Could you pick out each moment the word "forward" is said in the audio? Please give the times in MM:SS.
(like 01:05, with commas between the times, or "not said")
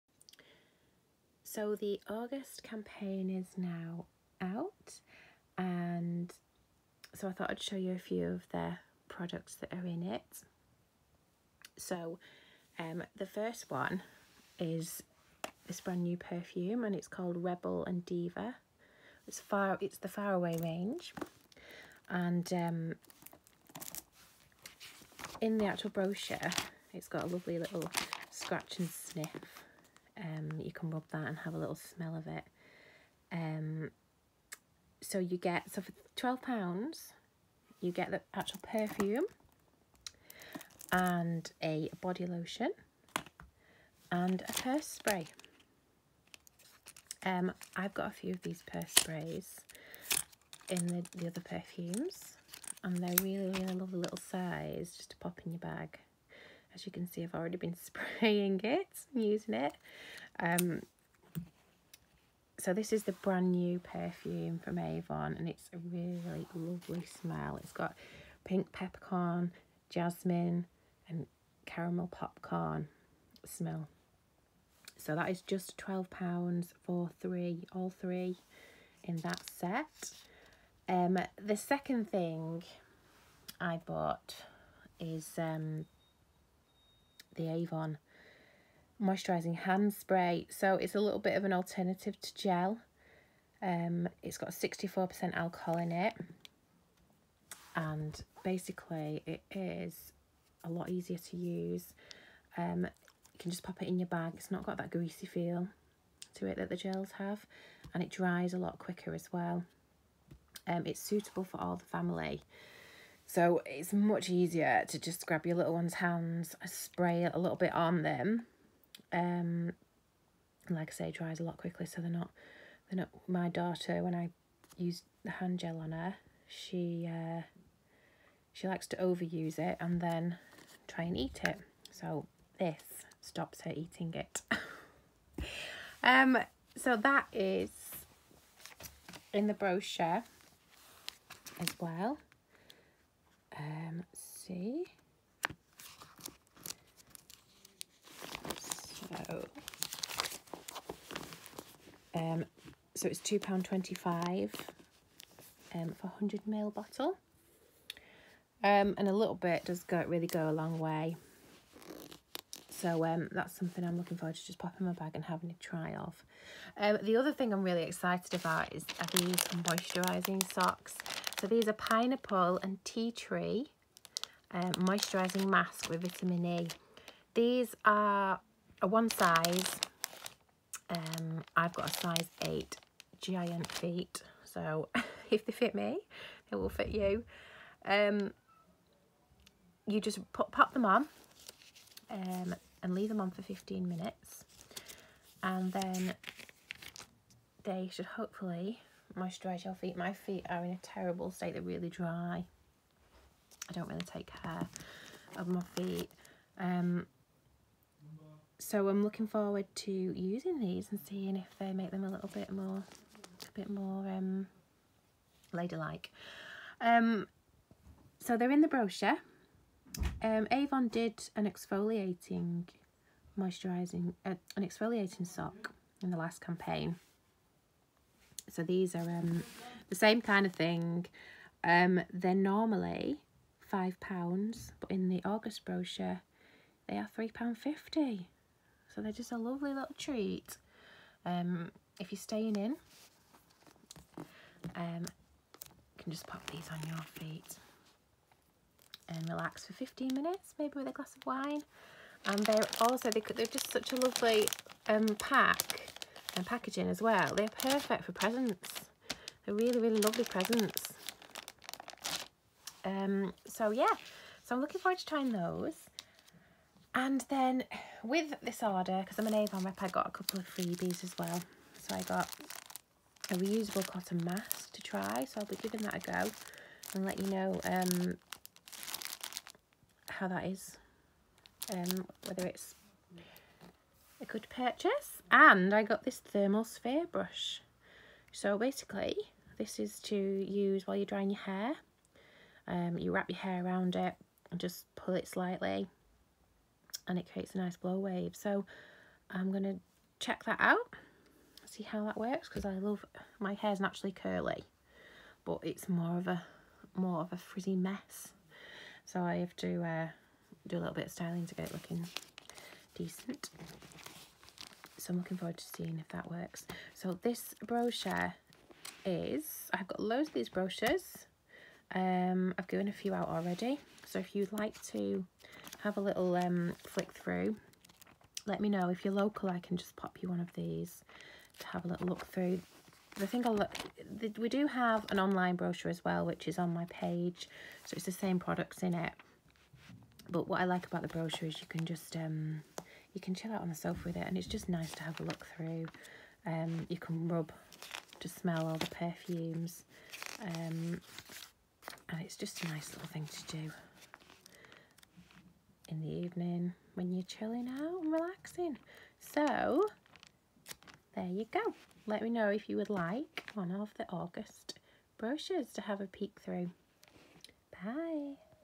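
02:44, 03:29, 04:24, 05:15.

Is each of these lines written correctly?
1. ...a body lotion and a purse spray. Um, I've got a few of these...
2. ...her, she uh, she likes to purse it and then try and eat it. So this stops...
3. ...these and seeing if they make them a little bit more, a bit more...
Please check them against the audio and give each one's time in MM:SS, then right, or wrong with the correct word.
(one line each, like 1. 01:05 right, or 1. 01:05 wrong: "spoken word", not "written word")
1. 00:41 right
2. 02:05 wrong: "overuse", not "purse"
3. 03:30 right.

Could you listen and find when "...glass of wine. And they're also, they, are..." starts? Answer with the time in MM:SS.
04:10.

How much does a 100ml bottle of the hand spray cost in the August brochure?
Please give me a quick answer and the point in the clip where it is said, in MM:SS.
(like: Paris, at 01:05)
£2.25, at 02:33.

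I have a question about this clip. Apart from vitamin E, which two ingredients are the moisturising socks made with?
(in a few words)
Pineapple and tea tree.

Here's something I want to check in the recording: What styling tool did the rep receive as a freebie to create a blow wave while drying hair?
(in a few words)
Thermal sphere brush.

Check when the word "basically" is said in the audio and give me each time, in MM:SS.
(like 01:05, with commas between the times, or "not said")
01:38, 04:48.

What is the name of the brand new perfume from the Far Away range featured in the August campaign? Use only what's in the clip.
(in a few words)
Rebel and Diva.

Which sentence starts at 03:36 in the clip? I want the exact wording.
Um, so they're in the brochure.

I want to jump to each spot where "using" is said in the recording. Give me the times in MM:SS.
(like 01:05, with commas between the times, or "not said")
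00:59, 03:29.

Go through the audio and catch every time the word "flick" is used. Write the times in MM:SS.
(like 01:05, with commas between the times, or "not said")
05:26.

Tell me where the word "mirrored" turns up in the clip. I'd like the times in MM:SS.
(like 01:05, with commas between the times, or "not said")
not said.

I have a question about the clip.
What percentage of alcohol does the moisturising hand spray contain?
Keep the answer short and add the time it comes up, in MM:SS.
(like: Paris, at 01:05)
64%, at 01:34.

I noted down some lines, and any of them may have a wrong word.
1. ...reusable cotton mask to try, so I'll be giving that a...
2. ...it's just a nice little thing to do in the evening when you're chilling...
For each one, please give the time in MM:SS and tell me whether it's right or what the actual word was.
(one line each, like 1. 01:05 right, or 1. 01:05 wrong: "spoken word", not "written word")
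1. 04:33 right
2. 05:52 right.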